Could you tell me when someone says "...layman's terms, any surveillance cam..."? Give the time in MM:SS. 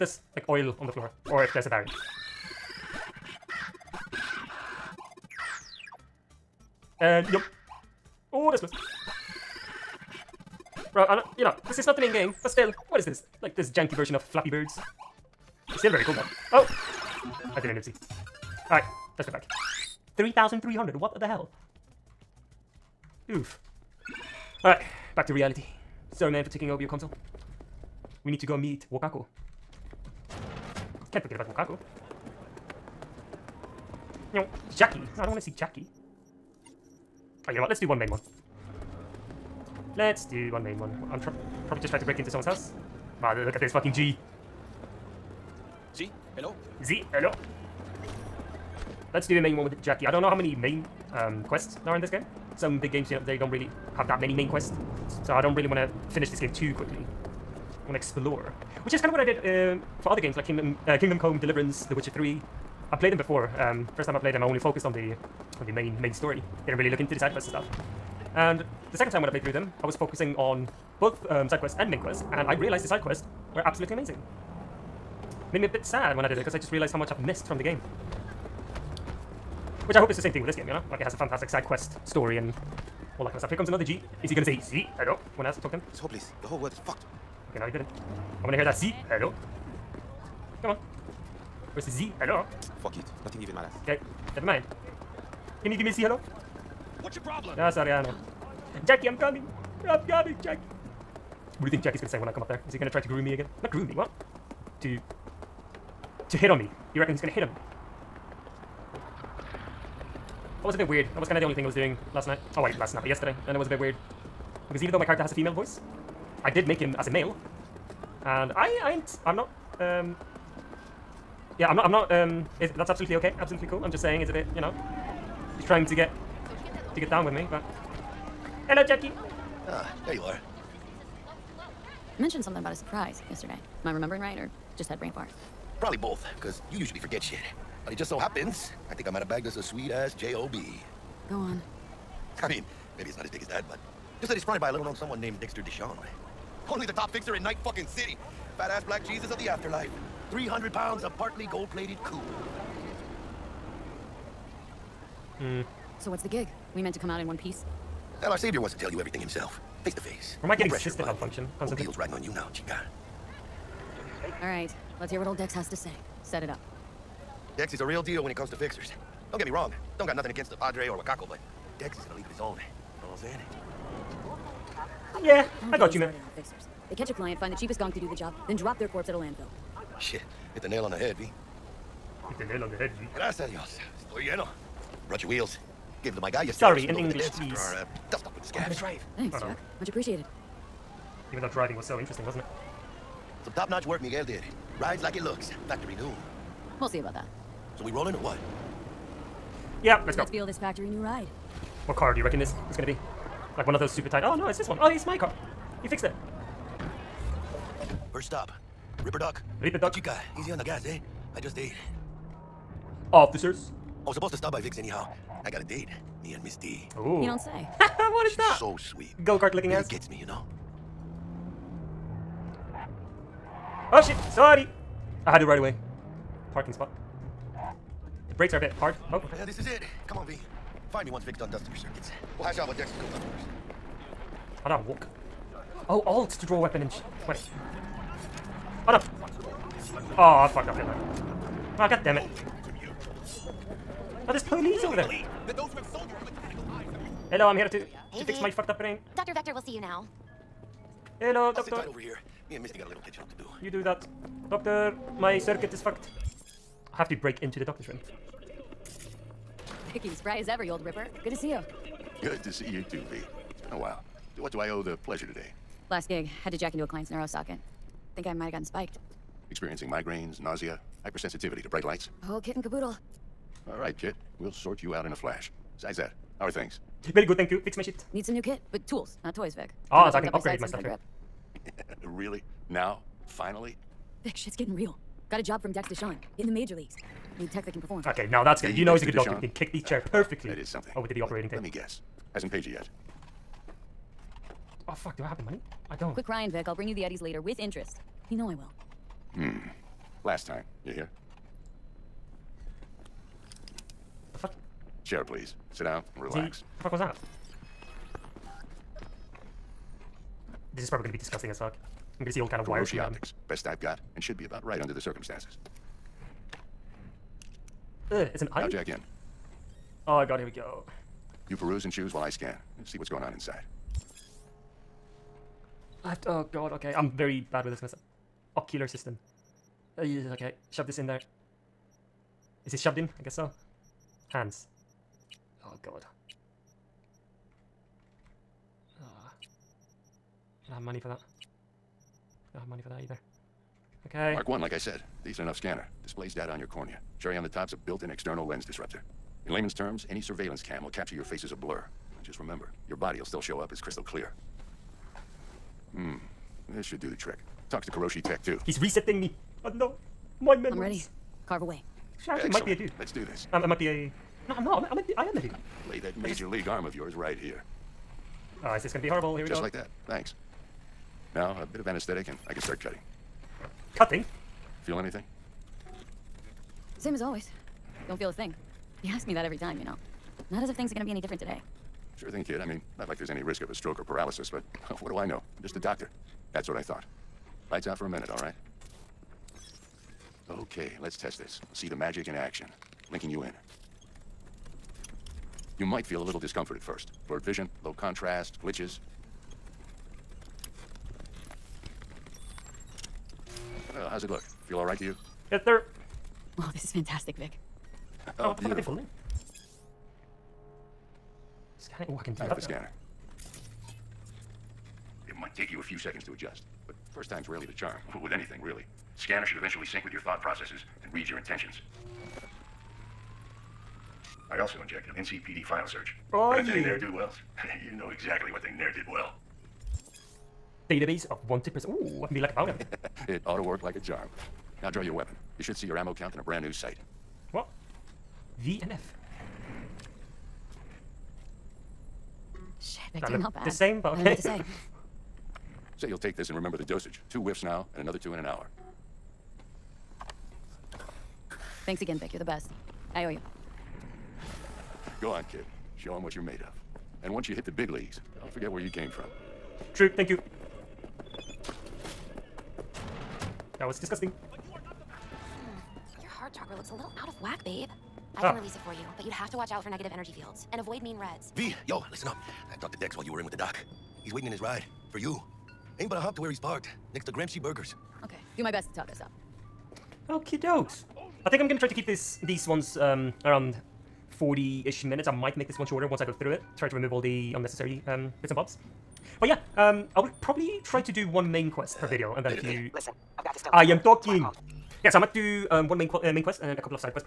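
05:49.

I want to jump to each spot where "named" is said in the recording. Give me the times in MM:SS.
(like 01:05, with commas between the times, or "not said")
02:25.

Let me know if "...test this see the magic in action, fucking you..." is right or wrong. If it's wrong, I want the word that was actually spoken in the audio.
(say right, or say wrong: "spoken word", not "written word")
wrong: "linking", not "fucking".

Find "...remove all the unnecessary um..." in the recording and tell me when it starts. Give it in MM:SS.
08:06.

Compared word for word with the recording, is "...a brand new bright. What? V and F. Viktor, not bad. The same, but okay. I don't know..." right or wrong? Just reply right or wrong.
wrong.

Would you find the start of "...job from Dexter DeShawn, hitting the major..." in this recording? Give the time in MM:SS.
04:45.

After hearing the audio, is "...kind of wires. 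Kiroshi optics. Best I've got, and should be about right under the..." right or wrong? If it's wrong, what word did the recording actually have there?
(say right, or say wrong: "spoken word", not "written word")
right.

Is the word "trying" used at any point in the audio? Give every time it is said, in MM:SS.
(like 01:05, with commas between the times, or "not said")
00:41, 02:05.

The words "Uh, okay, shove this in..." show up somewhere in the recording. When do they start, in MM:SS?
05:29.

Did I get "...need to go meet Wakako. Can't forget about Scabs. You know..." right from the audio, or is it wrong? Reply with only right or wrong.
wrong.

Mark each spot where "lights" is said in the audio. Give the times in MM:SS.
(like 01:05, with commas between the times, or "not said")
04:31, 06:27.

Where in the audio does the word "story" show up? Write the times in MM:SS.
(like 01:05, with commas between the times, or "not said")
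01:06, 01:22.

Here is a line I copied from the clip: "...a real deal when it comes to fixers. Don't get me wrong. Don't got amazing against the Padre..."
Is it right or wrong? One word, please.
wrong.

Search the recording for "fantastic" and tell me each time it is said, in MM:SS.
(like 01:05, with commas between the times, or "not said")
01:21, 06:46.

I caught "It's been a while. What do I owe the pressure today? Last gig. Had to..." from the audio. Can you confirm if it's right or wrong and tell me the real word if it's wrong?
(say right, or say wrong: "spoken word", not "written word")
wrong: "pleasure", not "pressure".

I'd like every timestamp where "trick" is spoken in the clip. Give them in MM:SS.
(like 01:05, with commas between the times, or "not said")
05:57.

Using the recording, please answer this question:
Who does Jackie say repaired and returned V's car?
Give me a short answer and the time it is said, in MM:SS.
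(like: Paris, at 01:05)
Miguel, at 03:14.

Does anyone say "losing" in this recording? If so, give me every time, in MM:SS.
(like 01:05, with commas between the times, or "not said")
not said.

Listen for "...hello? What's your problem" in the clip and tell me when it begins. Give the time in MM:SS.
01:36.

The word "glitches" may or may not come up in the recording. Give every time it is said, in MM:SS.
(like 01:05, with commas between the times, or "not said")
06:38.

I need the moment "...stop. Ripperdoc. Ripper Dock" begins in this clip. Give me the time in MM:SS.
03:28.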